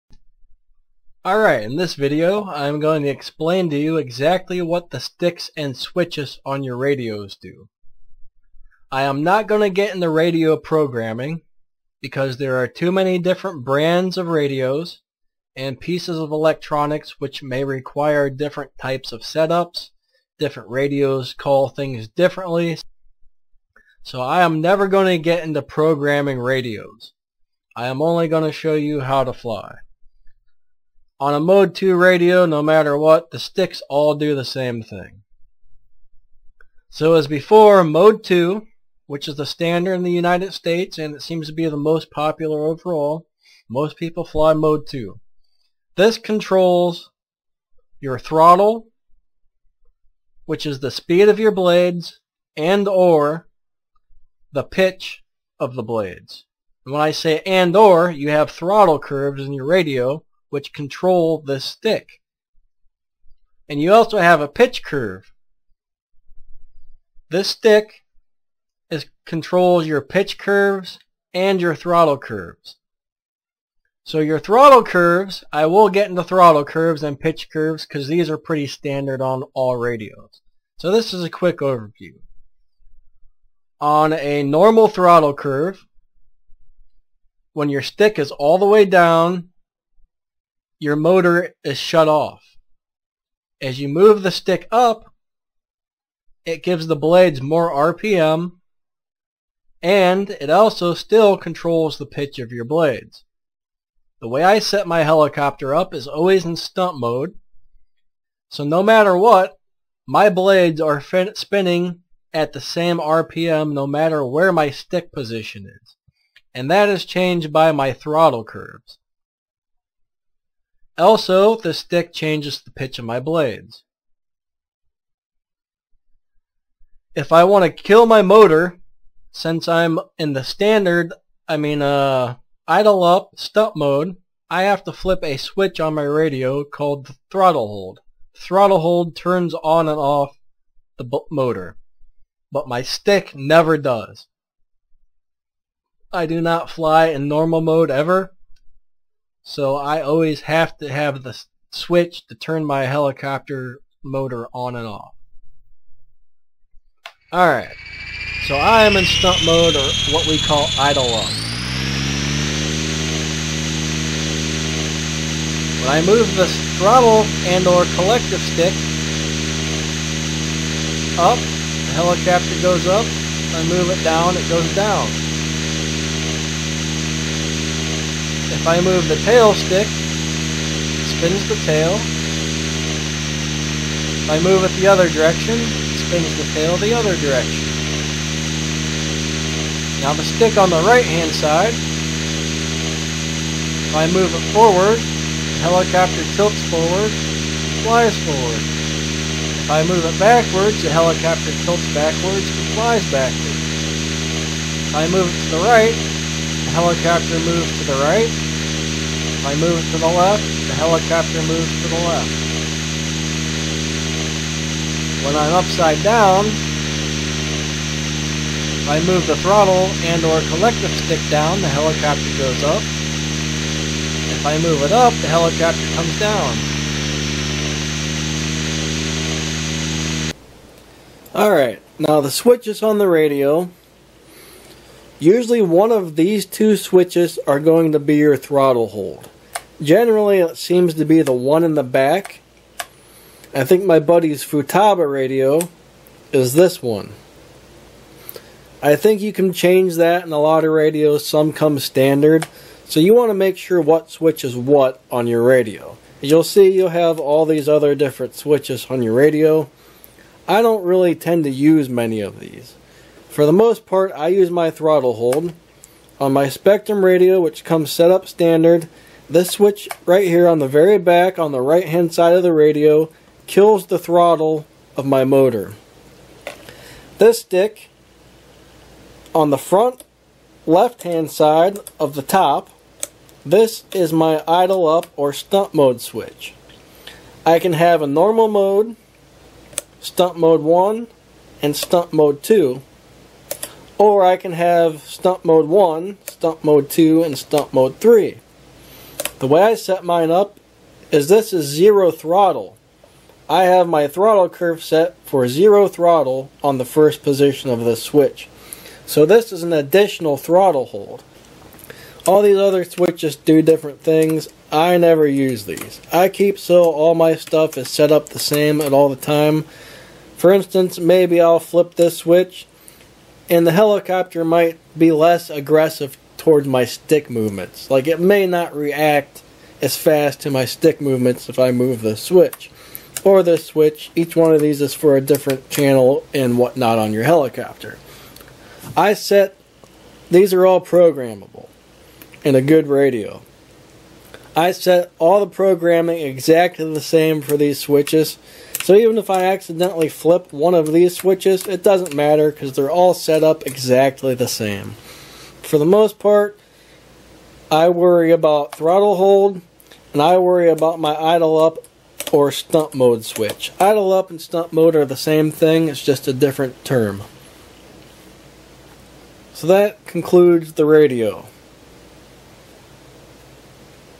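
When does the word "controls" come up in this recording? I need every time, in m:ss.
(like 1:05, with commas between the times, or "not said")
0:46, 1:00, 1:09, 1:41.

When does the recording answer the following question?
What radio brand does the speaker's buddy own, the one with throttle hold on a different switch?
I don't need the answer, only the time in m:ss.
4:04.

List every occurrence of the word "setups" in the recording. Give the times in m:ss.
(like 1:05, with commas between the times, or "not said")
0:19.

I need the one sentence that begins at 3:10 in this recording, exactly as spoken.
Now the stick on the right hand side, if I move it forward, the helicopter tilts forward, flies forward.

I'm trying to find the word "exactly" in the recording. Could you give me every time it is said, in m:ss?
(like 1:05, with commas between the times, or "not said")
0:03, 5:46, 5:53.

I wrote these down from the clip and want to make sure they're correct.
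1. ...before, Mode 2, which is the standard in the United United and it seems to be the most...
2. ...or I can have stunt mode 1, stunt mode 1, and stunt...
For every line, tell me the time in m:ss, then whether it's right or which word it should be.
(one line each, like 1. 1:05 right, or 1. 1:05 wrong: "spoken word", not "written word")
1. 0:37 wrong: "States", not "United"
2. 4:54 wrong: "2", not "1".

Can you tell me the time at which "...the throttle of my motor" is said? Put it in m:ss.
4:33.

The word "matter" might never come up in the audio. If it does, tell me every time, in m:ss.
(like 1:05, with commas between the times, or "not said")
0:32, 1:48, 1:53, 5:52.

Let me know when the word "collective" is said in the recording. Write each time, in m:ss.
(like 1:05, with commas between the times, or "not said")
2:47, 3:40.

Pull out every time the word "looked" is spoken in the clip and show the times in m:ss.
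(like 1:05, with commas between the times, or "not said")
not said.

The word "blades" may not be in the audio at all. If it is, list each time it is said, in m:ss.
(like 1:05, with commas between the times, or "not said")
0:51, 0:55, 1:36, 1:42, 1:50, 2:03.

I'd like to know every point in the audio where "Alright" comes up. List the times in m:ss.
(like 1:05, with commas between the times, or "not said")
0:01, 2:37, 3:51.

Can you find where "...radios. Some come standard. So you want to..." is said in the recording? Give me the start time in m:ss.
4:10.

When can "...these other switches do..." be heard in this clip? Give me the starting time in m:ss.
5:12.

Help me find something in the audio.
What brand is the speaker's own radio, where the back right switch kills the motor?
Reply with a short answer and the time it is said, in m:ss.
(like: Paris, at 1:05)
Spektrum, at 4:26.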